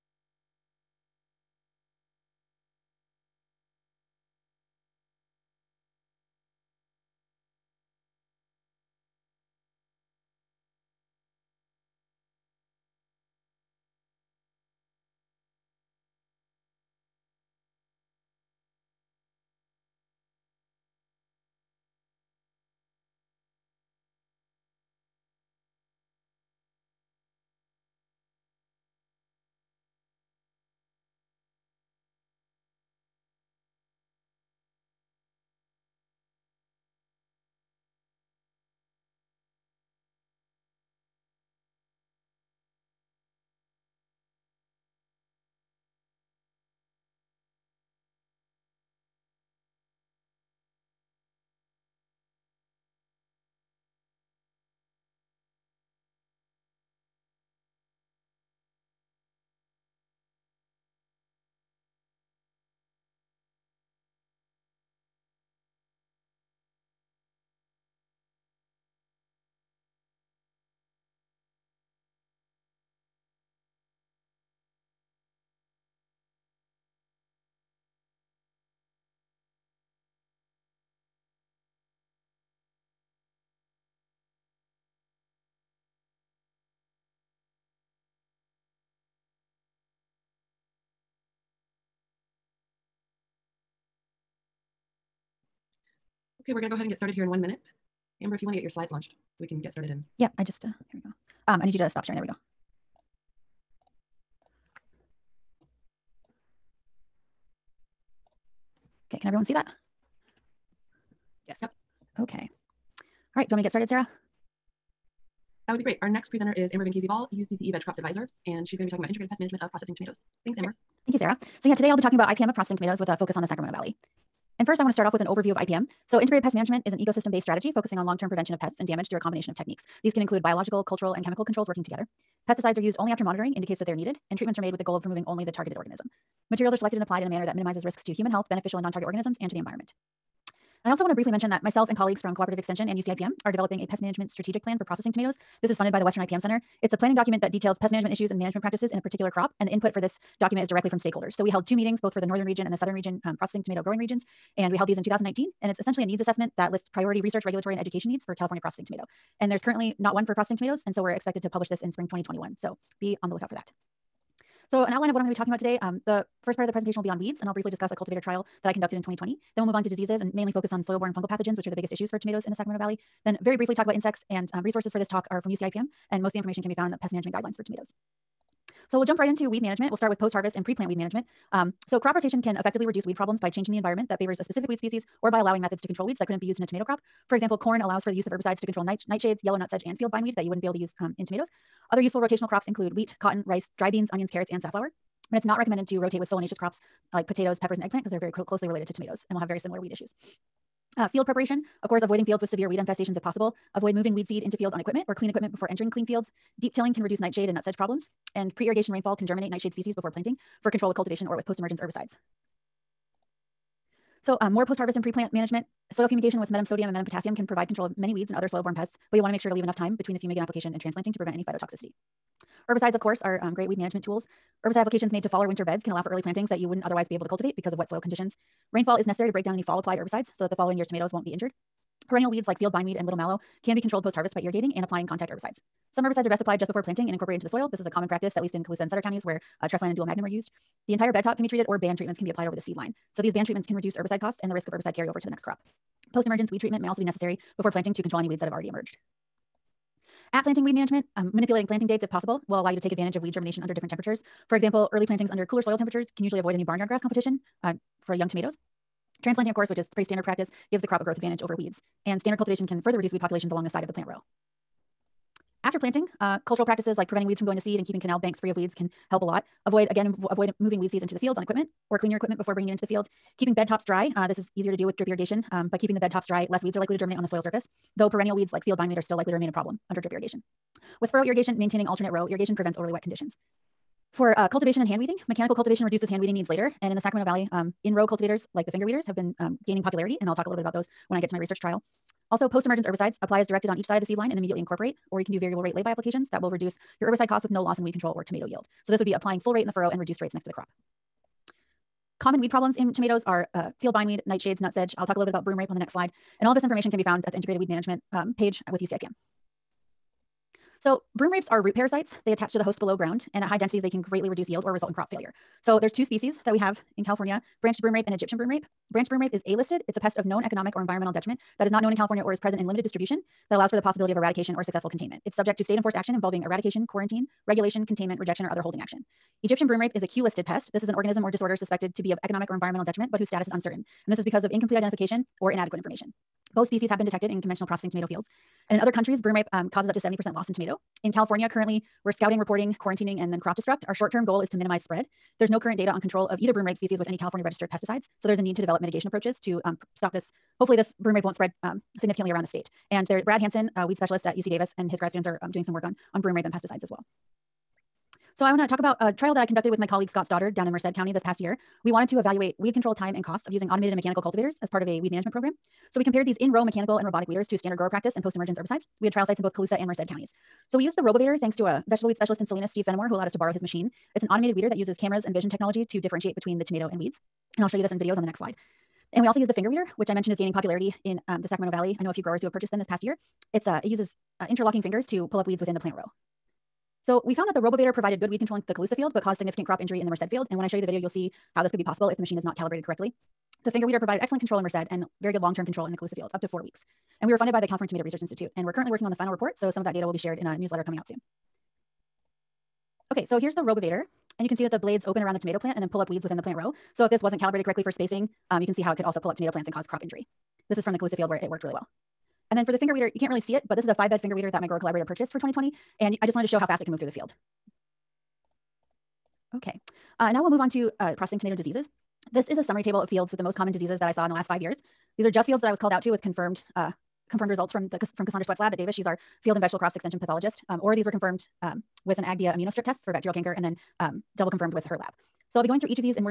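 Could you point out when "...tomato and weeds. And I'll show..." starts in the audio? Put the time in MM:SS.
06:16.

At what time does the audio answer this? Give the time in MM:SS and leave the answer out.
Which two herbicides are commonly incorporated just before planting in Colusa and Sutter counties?
03:59.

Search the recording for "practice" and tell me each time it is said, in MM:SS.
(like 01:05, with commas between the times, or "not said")
02:28, 03:58, 04:20, 04:26, 06:07.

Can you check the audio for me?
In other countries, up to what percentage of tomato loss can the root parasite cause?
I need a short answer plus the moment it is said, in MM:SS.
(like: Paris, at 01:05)
70%, at 05:39.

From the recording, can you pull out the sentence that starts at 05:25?
It's subject to state enforced action involving eradication, quarantine, regulation, containment, rejection, or other holding action.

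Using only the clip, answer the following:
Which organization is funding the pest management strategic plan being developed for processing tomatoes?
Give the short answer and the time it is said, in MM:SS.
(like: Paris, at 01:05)
Western IPM Center, at 02:26.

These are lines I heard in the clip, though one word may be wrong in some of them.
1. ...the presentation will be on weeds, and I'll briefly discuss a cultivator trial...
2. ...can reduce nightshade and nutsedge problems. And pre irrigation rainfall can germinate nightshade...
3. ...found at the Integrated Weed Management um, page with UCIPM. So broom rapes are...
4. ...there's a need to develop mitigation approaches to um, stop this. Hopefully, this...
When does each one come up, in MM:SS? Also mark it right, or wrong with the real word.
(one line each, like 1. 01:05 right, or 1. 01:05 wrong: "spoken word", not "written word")
1. 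02:46 right
2. 03:26 right
3. 05:07 right
4. 05:48 right.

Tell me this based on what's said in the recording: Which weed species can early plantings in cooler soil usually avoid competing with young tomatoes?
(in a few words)
barnyard grass.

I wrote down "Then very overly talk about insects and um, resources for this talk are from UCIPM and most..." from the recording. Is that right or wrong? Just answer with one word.
wrong.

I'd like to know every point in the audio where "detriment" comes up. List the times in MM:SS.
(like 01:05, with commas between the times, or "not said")
05:21, 05:32.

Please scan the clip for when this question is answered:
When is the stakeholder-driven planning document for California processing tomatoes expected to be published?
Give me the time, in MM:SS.
02:41.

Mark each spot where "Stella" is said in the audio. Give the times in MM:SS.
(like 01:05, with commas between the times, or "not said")
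not said.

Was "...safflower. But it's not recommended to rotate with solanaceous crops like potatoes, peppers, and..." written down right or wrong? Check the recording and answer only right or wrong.
right.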